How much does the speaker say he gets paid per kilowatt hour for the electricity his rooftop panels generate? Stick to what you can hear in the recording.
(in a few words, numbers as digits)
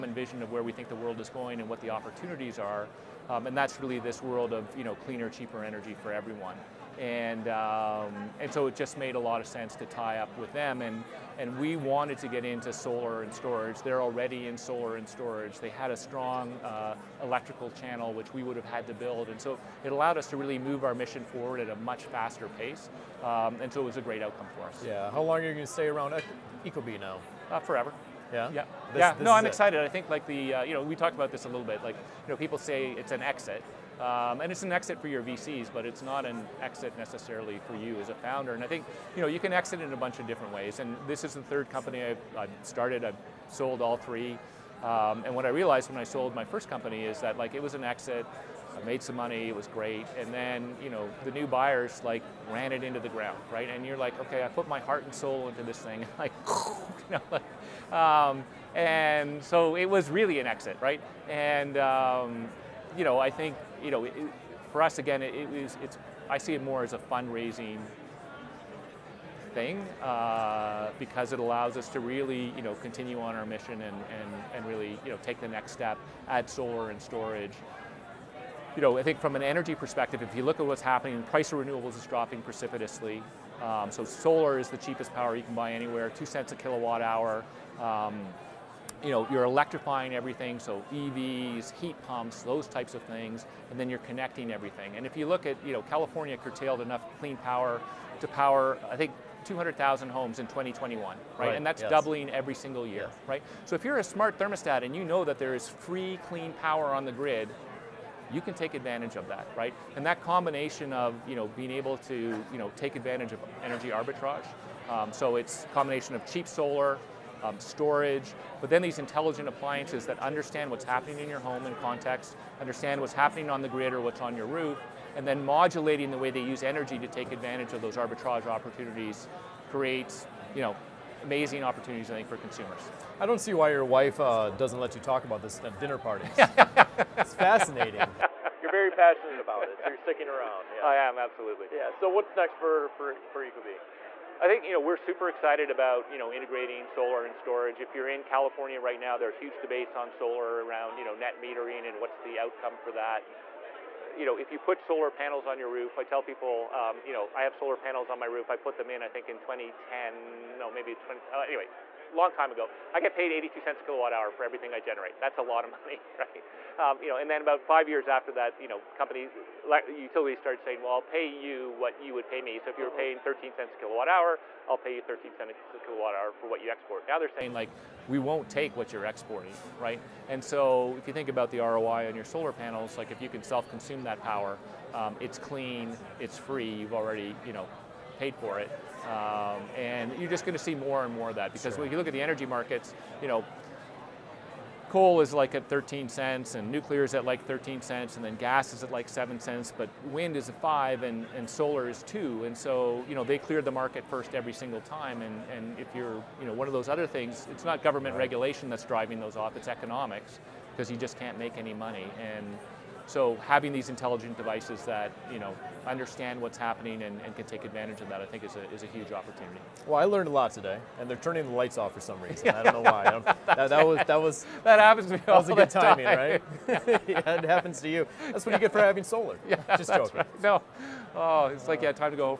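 82 cents.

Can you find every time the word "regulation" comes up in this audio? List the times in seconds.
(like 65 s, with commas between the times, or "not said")
208 s.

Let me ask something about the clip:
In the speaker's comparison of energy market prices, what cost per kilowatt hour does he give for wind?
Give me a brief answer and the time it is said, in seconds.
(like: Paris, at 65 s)
5 cents, at 200 s.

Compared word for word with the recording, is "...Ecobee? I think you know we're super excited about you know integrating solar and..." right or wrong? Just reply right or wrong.
right.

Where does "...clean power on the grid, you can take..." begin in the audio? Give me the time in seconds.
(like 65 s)
106 s.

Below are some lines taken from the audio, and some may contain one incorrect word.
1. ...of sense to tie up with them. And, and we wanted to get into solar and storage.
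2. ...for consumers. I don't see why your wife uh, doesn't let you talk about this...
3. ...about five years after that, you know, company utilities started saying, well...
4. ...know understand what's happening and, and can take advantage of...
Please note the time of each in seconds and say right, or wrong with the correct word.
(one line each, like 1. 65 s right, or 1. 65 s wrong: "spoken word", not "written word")
1. 9 s right
2. 132 s right
3. 167 s right
4. 215 s right.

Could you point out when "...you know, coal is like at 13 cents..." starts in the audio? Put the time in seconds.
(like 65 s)
193 s.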